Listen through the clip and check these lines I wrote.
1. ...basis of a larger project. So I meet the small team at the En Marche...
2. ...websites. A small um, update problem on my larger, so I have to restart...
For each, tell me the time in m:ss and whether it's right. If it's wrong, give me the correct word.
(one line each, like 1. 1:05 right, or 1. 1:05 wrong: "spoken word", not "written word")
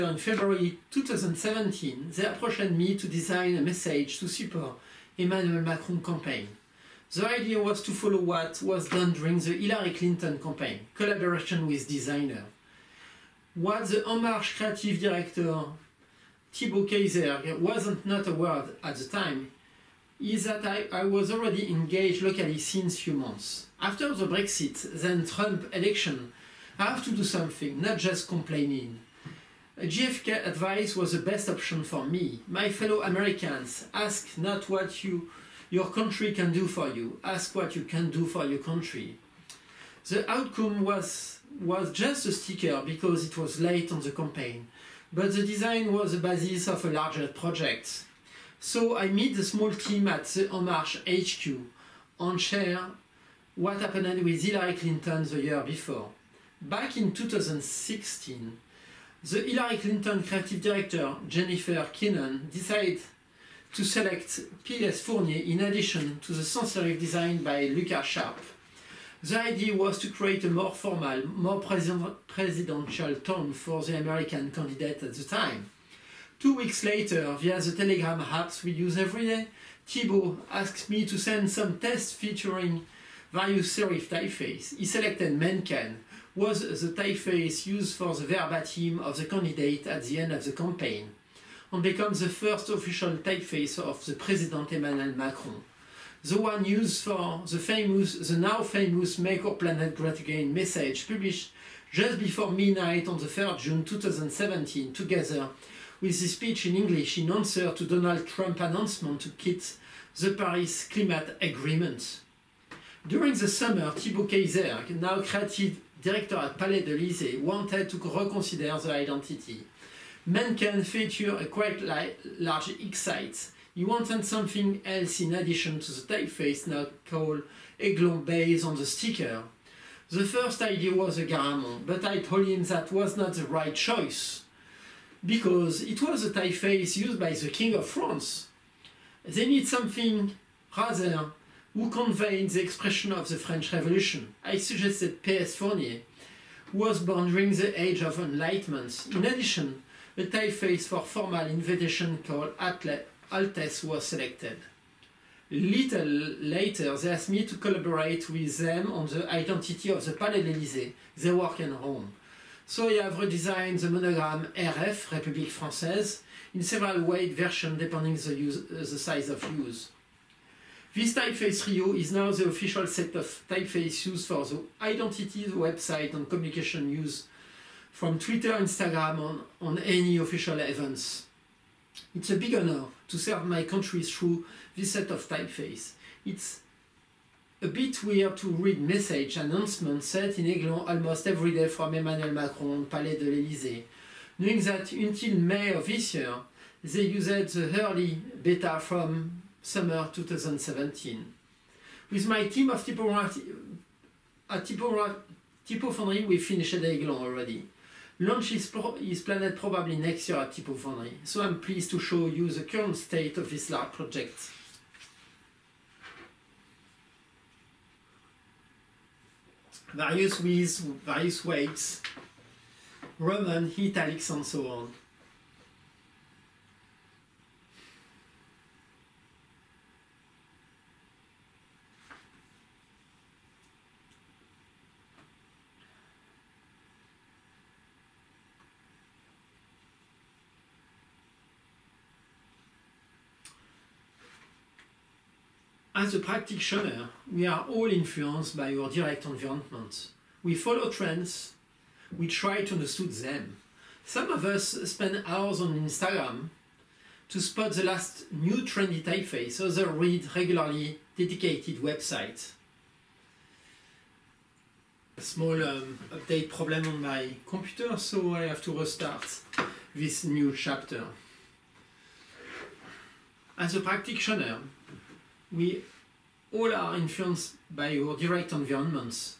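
1. 0:46 right
2. 4:21 wrong: "computer", not "larger".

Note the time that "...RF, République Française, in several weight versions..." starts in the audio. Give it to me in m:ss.
2:44.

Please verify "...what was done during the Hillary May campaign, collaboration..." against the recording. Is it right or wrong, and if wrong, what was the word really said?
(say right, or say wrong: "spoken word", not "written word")
wrong: "Clinton", not "May".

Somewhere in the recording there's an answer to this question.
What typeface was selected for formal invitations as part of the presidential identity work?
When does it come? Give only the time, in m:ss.
2:32.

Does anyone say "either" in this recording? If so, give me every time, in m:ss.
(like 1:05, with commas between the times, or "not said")
not said.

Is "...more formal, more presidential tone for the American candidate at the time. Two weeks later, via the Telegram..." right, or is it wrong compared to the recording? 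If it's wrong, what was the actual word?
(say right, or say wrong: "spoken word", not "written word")
right.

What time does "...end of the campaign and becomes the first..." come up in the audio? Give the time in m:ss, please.
1:30.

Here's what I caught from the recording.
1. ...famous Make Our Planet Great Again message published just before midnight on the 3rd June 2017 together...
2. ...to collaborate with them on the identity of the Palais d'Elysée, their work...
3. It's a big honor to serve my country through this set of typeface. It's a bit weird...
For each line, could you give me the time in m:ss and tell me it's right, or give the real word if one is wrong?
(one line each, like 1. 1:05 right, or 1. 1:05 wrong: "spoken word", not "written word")
1. 1:38 right
2. 2:37 right
3. 3:02 right.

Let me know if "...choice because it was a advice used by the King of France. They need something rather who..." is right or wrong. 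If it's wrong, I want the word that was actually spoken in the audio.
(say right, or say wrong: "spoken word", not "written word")
wrong: "typeface", not "advice".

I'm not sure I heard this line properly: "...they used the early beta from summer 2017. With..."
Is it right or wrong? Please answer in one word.
right.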